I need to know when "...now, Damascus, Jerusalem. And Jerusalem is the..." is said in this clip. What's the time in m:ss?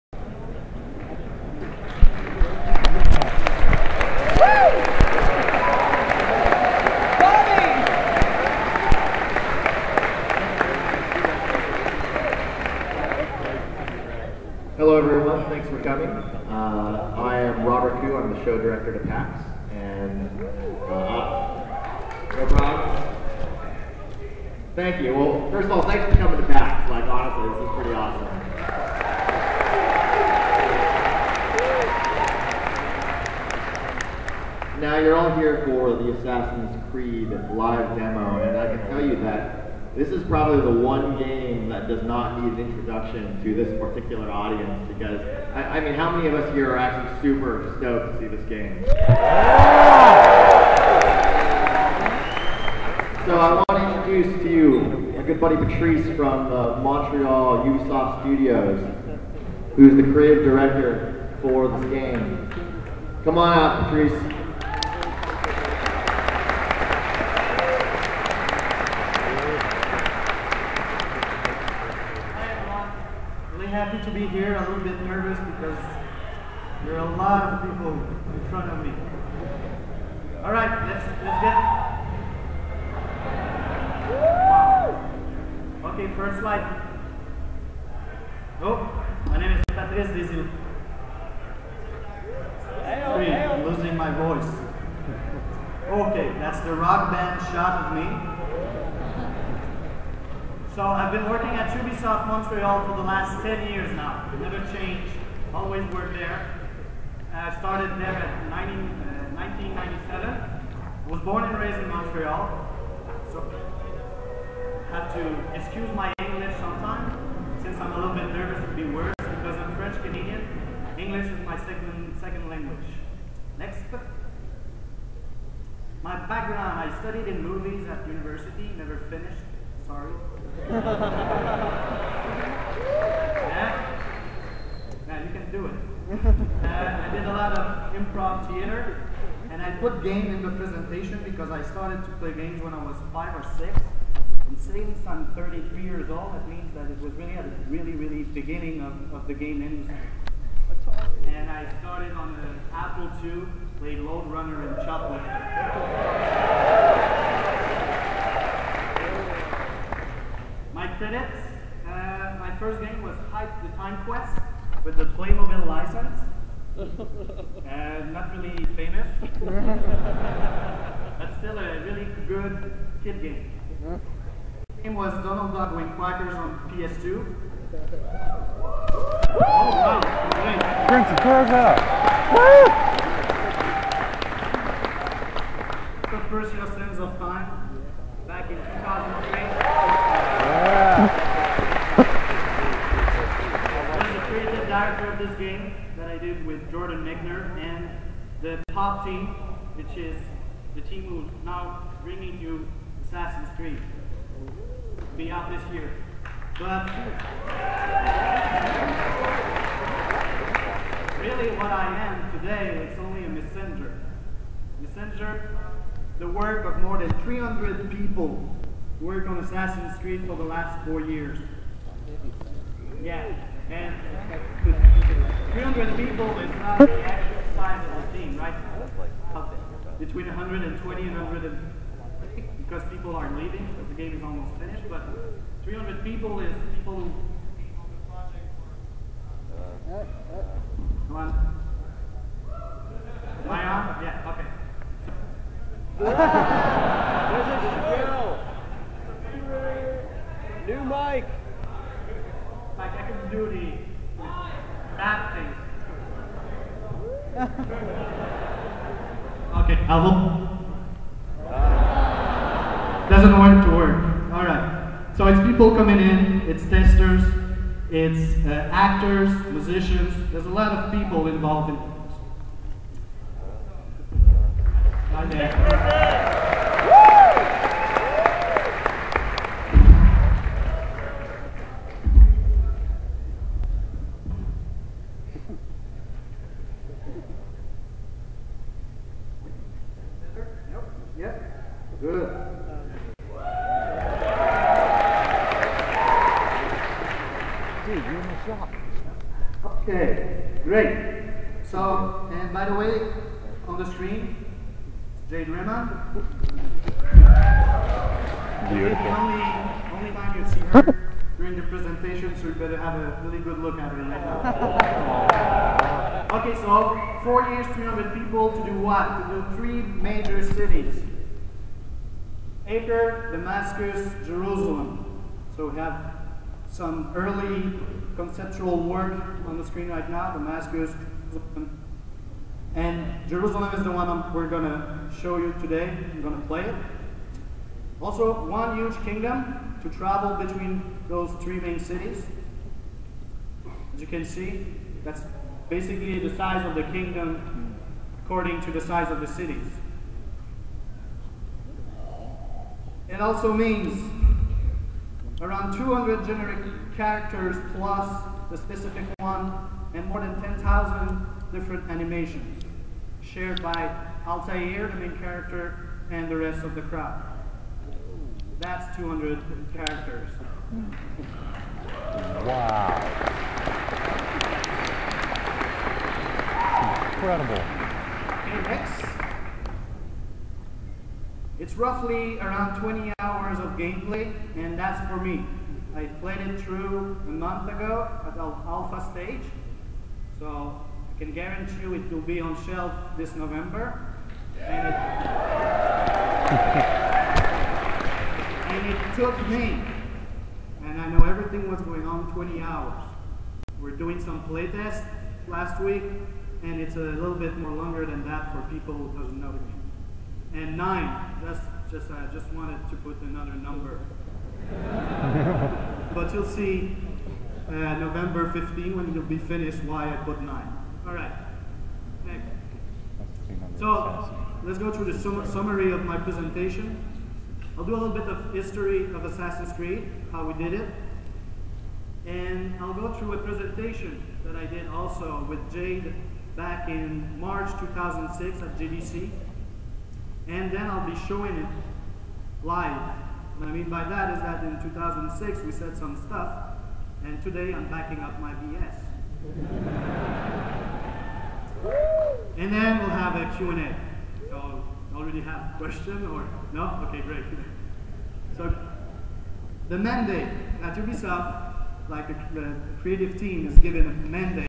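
5:30.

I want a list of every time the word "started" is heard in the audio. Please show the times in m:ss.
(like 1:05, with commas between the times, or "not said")
1:47, 2:21, 2:31.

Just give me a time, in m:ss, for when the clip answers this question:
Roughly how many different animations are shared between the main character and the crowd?
6:00.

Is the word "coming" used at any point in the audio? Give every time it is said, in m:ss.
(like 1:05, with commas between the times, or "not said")
0:15, 0:26, 4:25.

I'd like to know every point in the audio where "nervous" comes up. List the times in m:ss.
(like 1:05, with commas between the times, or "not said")
1:15, 1:58.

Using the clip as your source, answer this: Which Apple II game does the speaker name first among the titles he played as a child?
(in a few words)
Lode Runner.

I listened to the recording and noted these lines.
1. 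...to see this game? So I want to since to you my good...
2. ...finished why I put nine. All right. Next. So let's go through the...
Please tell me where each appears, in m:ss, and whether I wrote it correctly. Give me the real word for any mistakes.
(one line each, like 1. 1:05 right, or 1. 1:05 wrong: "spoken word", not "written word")
1. 0:48 wrong: "introduce", not "since"
2. 6:59 right.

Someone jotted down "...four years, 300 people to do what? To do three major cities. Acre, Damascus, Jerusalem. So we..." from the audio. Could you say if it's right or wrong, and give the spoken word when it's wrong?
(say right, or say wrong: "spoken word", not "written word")
right.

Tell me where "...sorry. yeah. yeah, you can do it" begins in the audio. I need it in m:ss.
2:09.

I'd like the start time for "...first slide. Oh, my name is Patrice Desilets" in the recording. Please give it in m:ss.
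1:26.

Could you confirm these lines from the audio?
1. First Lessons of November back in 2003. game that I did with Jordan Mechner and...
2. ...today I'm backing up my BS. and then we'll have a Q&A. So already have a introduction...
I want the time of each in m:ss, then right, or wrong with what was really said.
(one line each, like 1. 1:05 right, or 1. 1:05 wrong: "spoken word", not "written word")
1. 3:06 wrong: "Time", not "November"
2. 7:27 wrong: "question", not "introduction".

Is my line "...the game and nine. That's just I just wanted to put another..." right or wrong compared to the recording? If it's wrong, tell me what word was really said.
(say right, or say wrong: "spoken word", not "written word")
right.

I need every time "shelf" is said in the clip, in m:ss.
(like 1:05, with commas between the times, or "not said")
6:32.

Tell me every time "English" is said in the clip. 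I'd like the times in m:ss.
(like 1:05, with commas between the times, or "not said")
1:56, 2:00.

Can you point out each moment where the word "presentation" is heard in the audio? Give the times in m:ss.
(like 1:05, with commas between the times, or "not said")
2:20, 5:11, 7:06, 7:13.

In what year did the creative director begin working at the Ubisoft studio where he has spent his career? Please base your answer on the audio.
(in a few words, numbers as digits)
1997.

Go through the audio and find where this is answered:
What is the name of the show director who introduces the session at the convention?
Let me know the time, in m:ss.
0:17.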